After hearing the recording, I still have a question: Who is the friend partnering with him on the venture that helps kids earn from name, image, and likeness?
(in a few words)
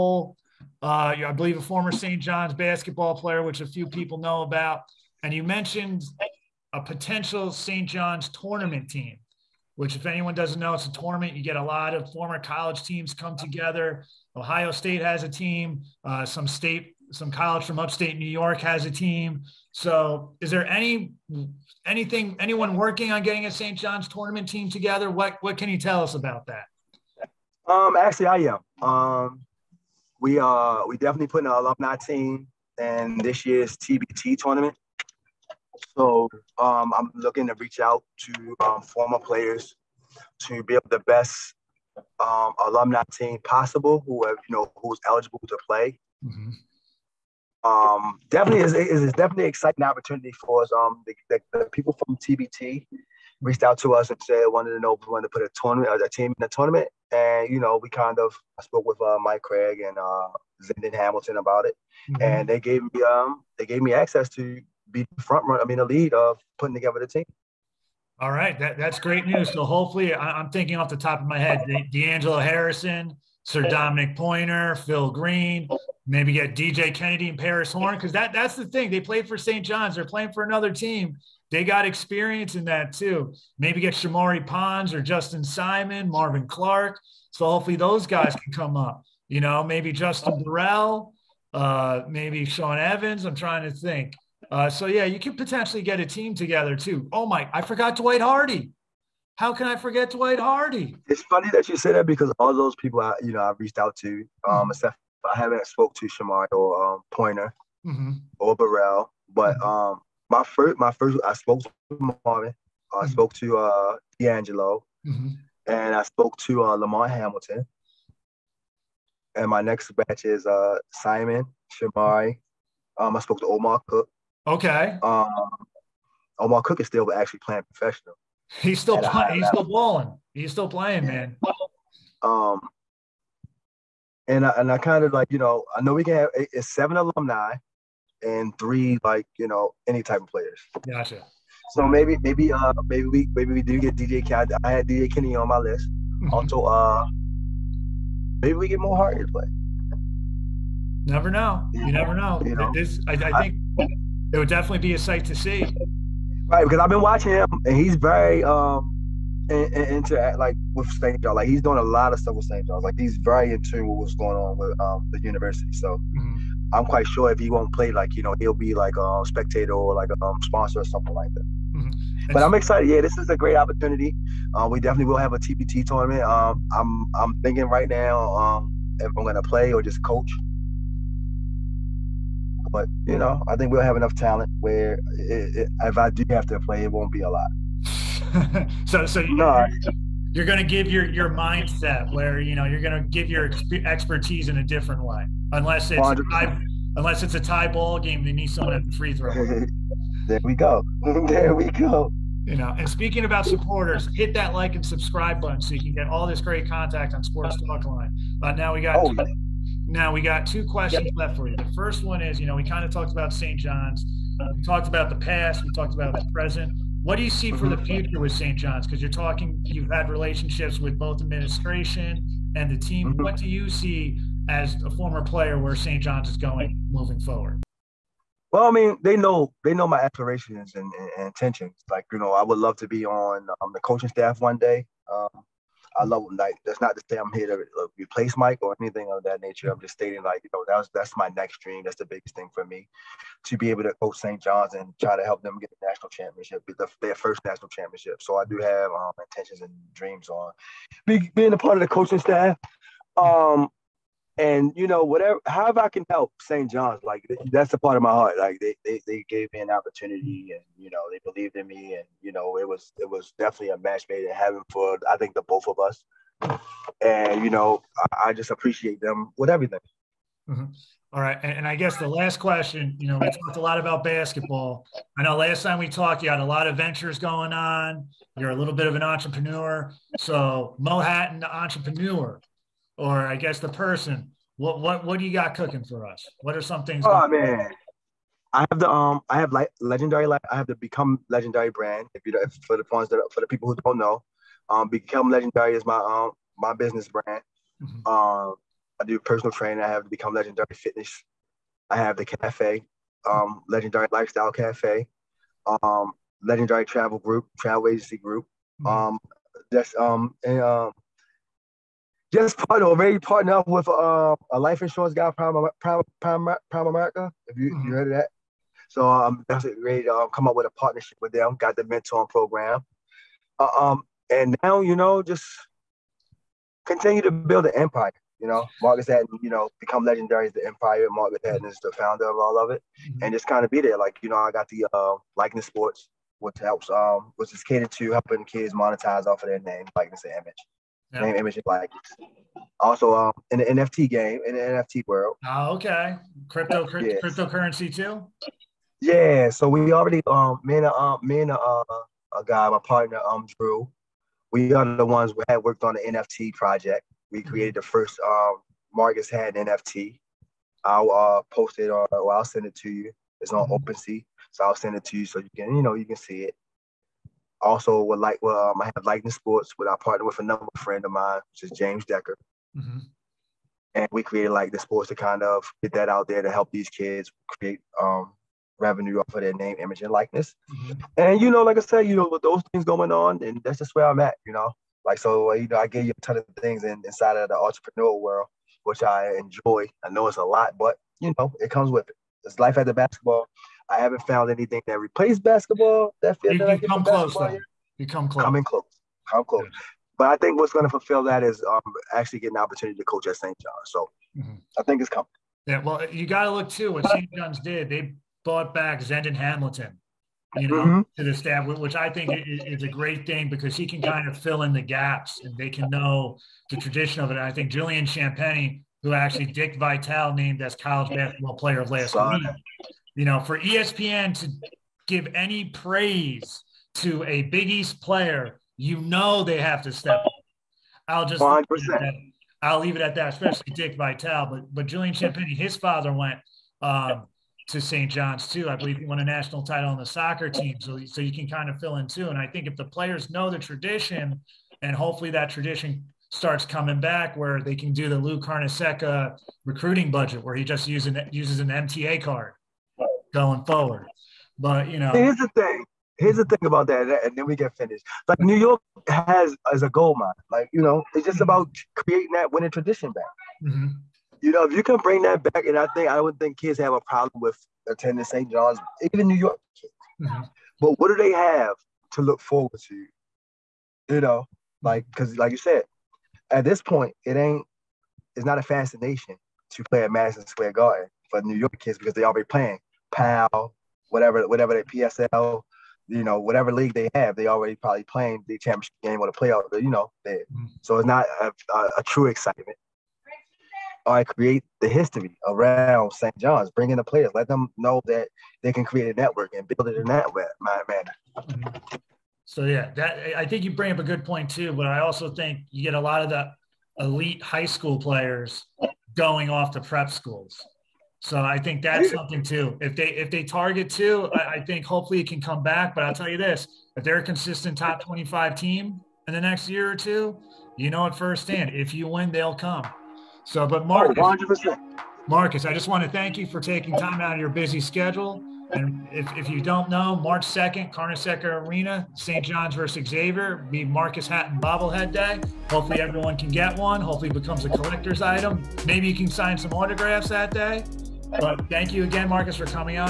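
James Decker.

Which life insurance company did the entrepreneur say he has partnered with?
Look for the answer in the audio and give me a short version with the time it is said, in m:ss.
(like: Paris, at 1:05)
Primerica, at 5:16.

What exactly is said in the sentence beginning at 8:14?
I create the history around St.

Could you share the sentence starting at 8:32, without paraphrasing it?
If they if they target two, I, I, think hopefully it can come back.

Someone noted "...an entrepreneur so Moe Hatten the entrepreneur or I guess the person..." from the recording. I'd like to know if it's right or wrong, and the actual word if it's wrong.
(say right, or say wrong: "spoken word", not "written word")
right.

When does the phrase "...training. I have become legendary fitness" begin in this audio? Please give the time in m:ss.
4:59.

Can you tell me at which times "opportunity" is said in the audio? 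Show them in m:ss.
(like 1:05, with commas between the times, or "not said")
0:49, 2:53, 4:19, 6:42.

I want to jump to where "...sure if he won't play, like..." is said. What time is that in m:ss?
2:47.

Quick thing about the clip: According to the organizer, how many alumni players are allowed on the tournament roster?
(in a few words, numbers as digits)
7.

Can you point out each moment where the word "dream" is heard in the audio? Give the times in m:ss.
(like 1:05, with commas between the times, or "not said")
4:01, 4:09.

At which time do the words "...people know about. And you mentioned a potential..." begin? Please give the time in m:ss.
0:03.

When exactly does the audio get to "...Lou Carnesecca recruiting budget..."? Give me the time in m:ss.
7:28.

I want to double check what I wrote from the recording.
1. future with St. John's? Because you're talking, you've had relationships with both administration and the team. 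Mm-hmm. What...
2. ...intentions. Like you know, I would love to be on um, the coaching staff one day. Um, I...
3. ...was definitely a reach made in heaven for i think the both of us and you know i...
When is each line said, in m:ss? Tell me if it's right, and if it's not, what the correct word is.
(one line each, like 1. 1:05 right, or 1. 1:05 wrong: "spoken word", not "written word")
1. 3:37 right
2. 3:51 right
3. 4:23 wrong: "match", not "reach".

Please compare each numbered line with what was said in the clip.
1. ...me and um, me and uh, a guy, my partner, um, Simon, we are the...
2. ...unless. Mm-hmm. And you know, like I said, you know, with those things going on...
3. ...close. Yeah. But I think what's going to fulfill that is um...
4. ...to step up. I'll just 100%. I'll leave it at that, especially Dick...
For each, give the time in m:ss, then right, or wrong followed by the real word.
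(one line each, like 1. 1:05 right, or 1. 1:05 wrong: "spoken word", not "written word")
1. 5:50 wrong: "Drew", not "Simon"
2. 6:20 wrong: "likeness", not "unless"
3. 6:39 right
4. 7:09 right.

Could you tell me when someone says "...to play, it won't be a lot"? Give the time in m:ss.
3:06.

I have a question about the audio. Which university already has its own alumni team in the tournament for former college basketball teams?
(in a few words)
Ohio State.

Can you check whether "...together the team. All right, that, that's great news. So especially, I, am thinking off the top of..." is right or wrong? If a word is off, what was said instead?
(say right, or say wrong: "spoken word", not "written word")
wrong: "hopefully", not "especially".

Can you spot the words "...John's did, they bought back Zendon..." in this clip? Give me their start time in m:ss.
6:47.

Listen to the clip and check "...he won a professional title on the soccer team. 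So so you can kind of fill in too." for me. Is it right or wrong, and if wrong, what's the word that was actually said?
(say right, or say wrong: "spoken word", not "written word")
wrong: "national", not "professional".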